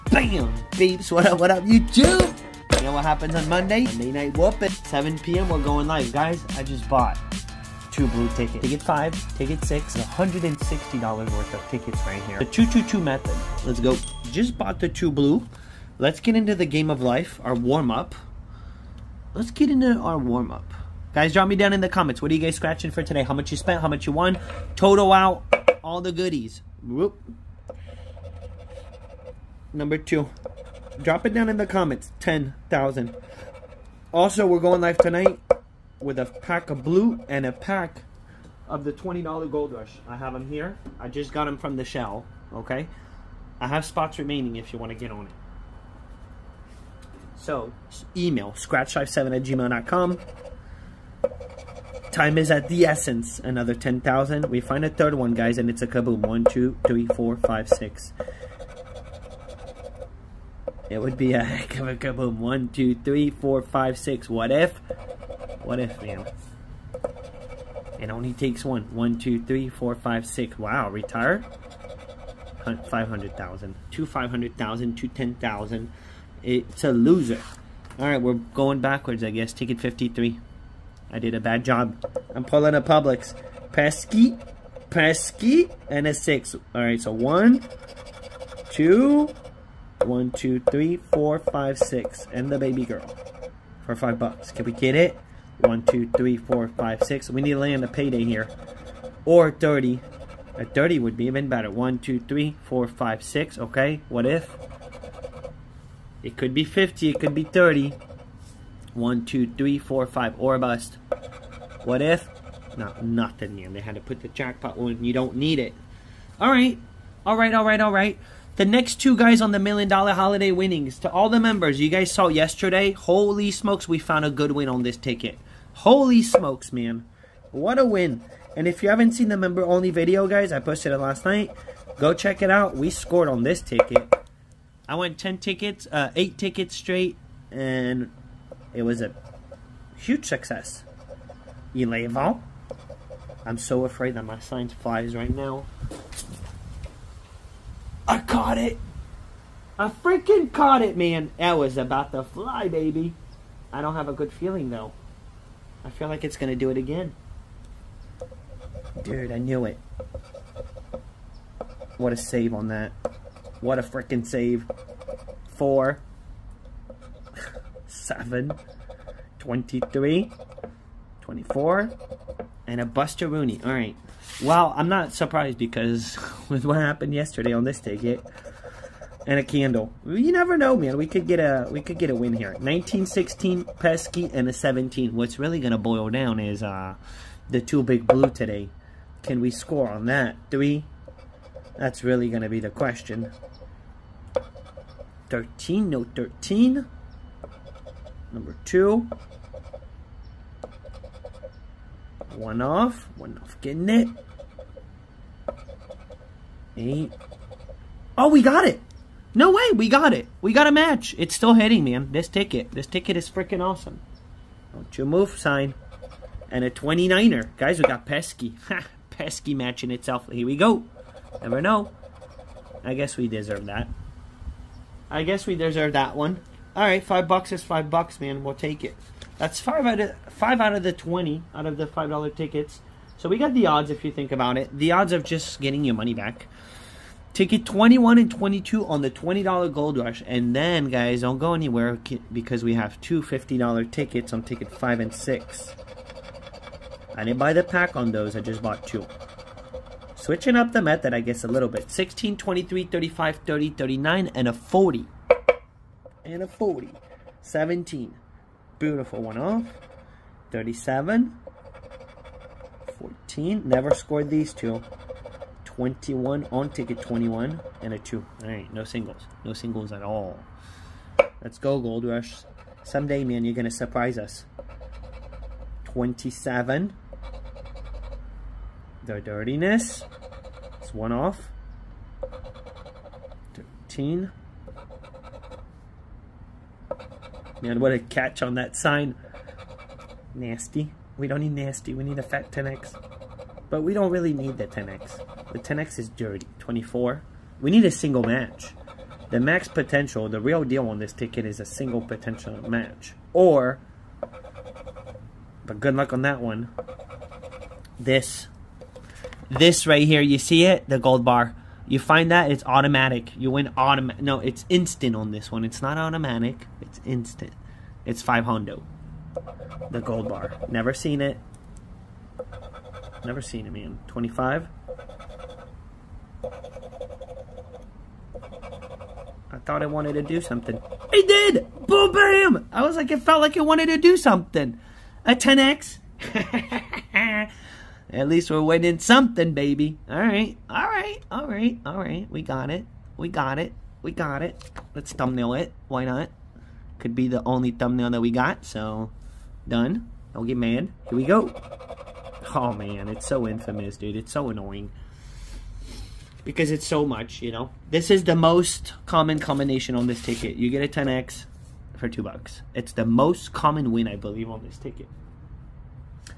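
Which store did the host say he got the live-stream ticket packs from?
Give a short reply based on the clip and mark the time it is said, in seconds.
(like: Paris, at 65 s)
Shell, at 41 s.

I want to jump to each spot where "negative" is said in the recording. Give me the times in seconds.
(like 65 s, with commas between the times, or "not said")
not said.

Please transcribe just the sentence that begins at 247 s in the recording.
I didn't buy the pack on those.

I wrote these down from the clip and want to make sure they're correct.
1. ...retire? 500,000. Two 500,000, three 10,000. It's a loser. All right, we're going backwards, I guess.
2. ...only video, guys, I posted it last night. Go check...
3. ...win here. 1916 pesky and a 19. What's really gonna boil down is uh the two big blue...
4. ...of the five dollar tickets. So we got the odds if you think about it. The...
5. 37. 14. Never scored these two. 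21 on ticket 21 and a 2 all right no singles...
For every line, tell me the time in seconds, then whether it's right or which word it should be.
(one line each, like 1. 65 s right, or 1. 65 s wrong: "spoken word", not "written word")
1. 70 s wrong: "two", not "three"
2. 129 s right
3. 182 s wrong: "17", not "19"
4. 231 s right
5. 260 s right.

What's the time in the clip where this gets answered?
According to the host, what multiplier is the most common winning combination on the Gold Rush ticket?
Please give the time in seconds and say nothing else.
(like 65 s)
360 s.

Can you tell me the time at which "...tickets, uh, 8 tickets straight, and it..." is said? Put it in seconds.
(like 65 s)
135 s.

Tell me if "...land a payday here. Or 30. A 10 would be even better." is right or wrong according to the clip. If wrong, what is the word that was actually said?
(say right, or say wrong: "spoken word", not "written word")
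wrong: "30", not "10".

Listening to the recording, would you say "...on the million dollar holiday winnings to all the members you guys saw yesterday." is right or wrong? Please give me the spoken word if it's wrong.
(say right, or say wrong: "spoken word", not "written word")
right.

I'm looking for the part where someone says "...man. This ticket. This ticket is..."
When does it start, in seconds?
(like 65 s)
211 s.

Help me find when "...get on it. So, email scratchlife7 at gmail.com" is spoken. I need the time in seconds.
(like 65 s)
44 s.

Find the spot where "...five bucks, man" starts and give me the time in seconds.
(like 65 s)
227 s.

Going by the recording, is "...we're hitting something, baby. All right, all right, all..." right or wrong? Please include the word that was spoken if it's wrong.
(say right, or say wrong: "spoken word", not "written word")
wrong: "winning", not "hitting".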